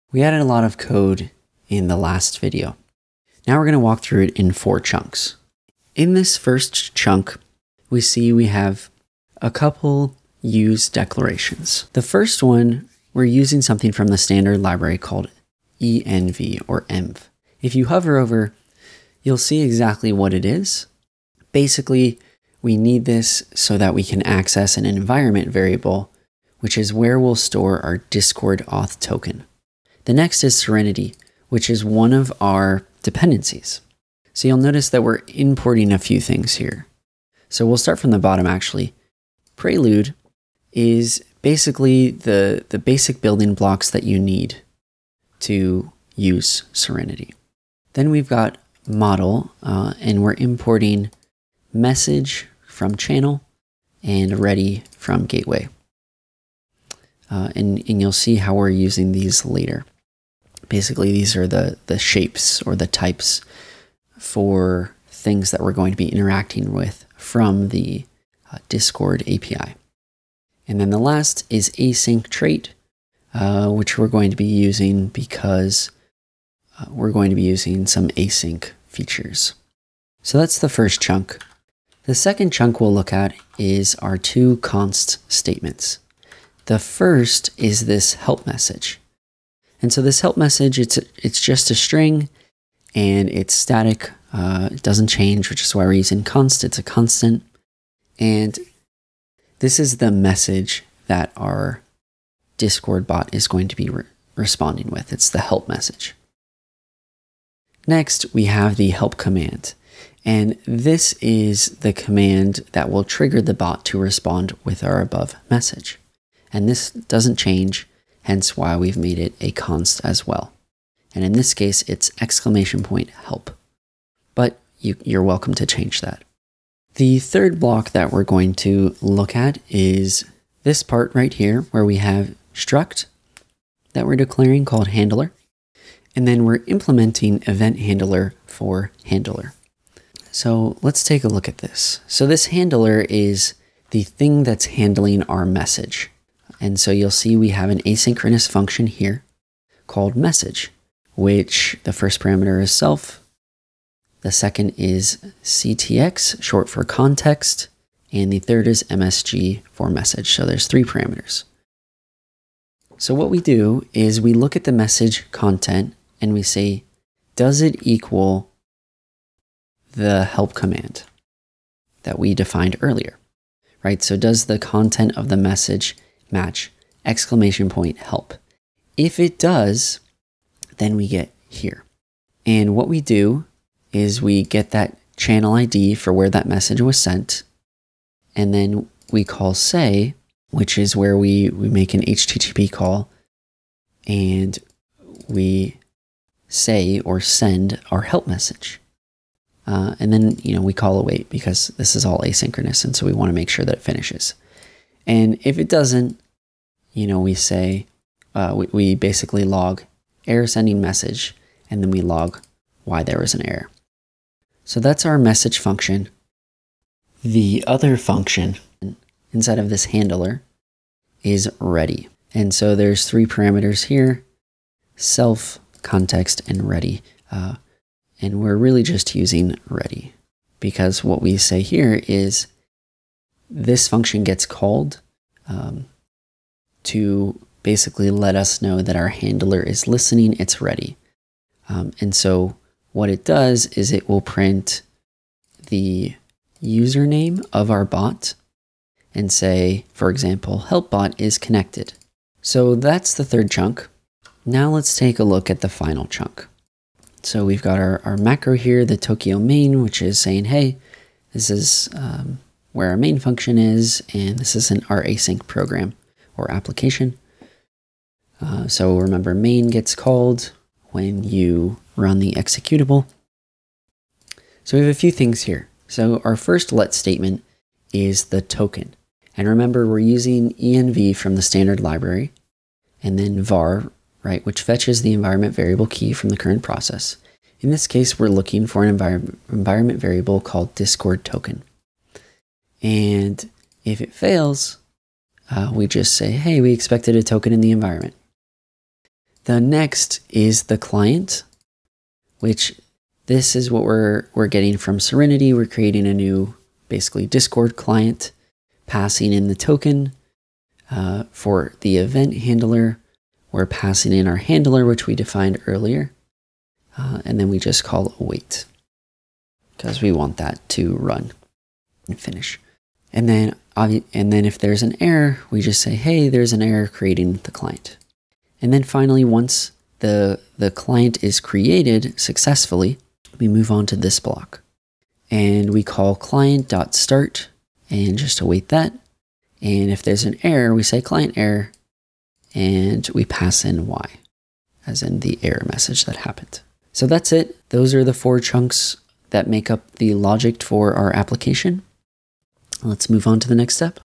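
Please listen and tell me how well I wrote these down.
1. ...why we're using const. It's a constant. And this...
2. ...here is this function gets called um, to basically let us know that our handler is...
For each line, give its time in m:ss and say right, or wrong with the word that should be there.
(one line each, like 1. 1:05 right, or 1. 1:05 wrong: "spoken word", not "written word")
1. 1:35 right
2. 3:51 right.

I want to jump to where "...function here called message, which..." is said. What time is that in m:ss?
2:28.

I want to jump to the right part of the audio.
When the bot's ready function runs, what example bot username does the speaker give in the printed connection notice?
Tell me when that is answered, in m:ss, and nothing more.
4:10.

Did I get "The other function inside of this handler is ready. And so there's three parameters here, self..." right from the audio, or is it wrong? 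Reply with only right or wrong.
right.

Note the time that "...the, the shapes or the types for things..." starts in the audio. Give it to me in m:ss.
1:01.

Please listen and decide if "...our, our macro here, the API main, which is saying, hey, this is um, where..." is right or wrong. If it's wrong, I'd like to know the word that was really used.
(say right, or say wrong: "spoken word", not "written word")
wrong: "Tokio", not "API".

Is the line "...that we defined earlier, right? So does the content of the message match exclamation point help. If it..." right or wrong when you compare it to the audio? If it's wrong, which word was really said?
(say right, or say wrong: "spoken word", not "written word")
right.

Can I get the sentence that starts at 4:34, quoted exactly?
So we have a few things here.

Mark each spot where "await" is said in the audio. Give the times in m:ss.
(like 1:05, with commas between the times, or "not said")
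3:20, 5:18, 5:38.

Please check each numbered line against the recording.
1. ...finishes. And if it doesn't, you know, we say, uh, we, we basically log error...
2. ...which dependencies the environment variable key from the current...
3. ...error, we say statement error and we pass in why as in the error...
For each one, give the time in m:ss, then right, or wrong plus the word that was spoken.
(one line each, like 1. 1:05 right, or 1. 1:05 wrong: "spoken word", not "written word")
1. 3:23 right
2. 4:44 wrong: "fetches", not "dependencies"
3. 5:40 wrong: "client", not "statement".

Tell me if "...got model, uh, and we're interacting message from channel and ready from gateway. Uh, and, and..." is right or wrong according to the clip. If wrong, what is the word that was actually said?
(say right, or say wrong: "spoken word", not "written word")
wrong: "importing", not "interacting".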